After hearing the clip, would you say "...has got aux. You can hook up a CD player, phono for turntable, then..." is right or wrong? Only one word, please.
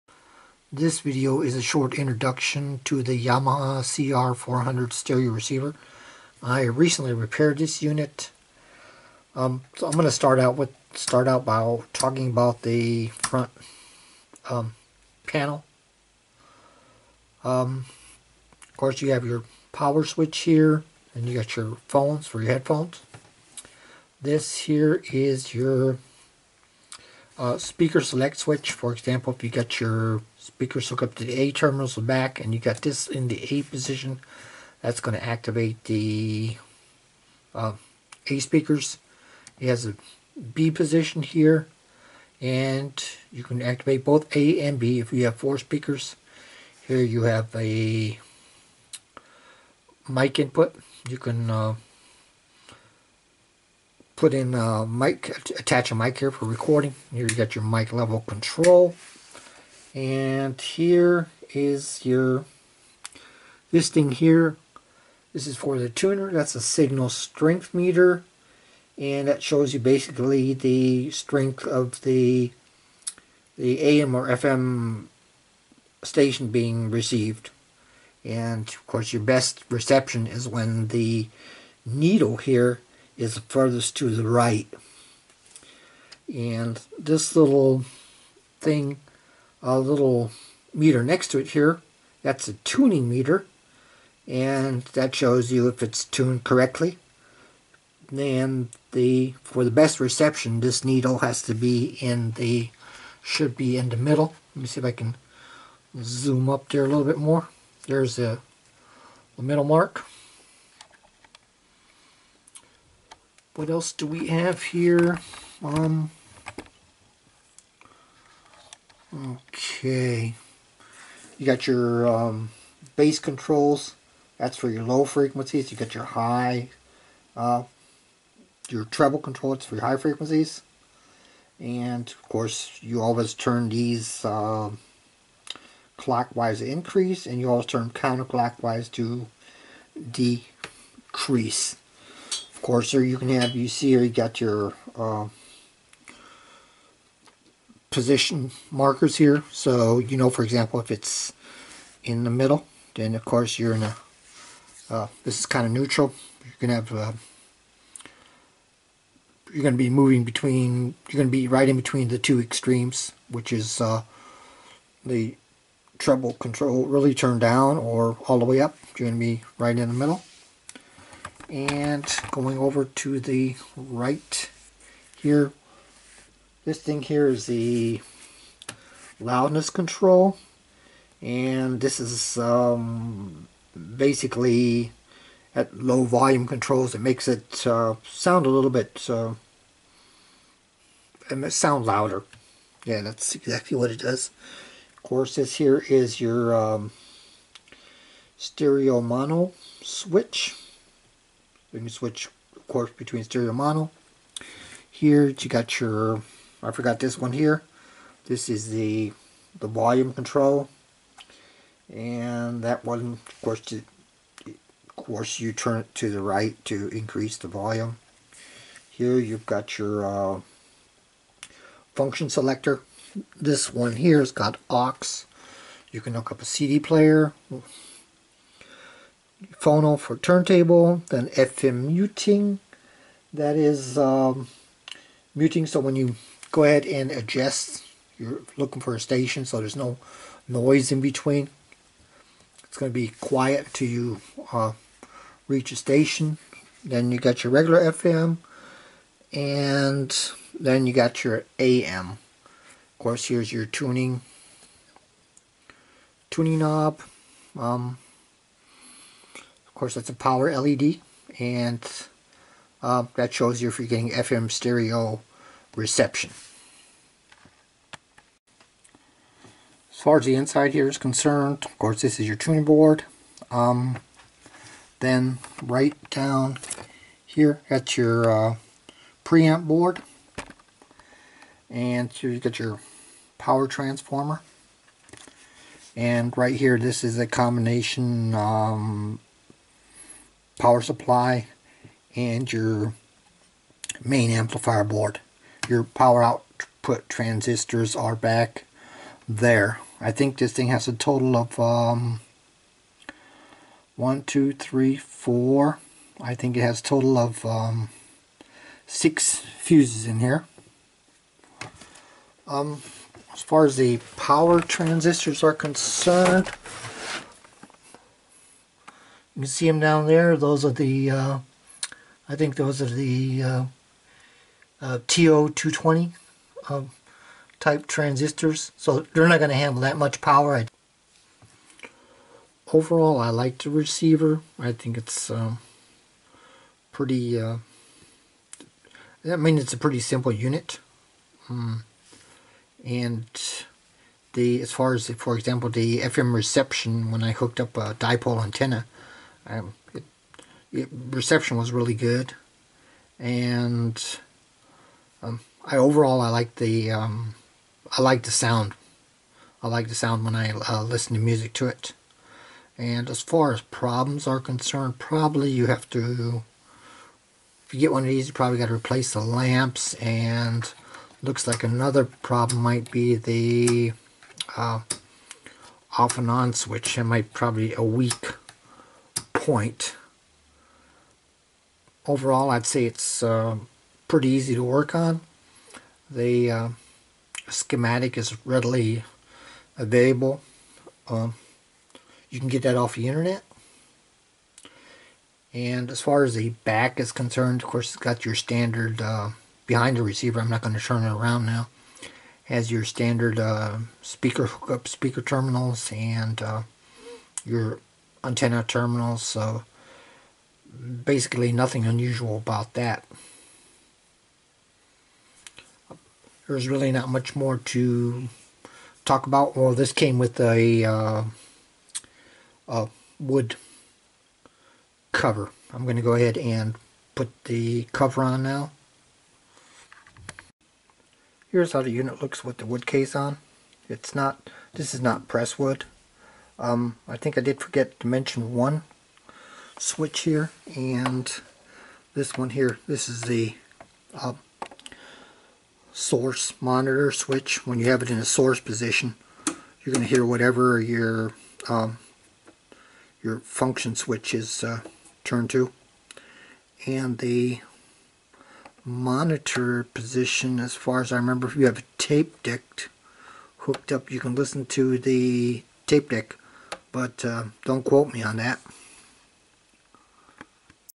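right.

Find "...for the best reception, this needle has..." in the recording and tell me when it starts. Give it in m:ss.
1:39.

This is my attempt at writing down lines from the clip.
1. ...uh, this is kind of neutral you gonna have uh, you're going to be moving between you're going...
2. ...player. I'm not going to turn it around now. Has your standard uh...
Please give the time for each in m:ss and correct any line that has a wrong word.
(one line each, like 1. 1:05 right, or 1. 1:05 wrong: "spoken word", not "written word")
1. 2:34 right
2. 6:40 wrong: "receiver", not "player".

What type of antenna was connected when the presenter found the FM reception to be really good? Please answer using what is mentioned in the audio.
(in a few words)
dipole antenna.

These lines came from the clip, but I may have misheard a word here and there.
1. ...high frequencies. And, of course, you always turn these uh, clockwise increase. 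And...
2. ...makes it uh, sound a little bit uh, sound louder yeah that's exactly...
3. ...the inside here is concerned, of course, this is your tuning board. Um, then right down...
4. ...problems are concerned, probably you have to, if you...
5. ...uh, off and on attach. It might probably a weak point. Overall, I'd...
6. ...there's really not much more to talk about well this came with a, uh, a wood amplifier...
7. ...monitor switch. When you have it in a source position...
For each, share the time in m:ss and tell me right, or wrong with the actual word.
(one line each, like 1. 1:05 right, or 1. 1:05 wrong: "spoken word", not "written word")
1. 2:09 right
2. 3:07 right
3. 4:30 right
4. 6:03 right
5. 6:14 wrong: "switch", not "attach"
6. 6:56 wrong: "cover", not "amplifier"
7. 7:26 right.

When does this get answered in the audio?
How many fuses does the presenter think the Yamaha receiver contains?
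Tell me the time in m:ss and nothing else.
5:08.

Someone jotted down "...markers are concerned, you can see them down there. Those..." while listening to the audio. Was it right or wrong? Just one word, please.
wrong.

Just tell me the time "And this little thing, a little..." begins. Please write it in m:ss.
1:26.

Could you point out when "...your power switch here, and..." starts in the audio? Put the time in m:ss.
0:19.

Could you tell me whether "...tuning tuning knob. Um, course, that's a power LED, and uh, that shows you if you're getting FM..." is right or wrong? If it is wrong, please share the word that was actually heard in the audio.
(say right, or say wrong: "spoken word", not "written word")
right.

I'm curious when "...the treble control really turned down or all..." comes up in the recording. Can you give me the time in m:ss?
2:45.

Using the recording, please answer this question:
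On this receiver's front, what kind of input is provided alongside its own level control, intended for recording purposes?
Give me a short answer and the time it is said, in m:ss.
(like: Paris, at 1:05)
mic input, at 0:50.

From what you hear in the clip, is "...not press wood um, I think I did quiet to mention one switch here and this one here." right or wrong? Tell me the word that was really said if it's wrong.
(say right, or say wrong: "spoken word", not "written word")
wrong: "forget", not "quiet".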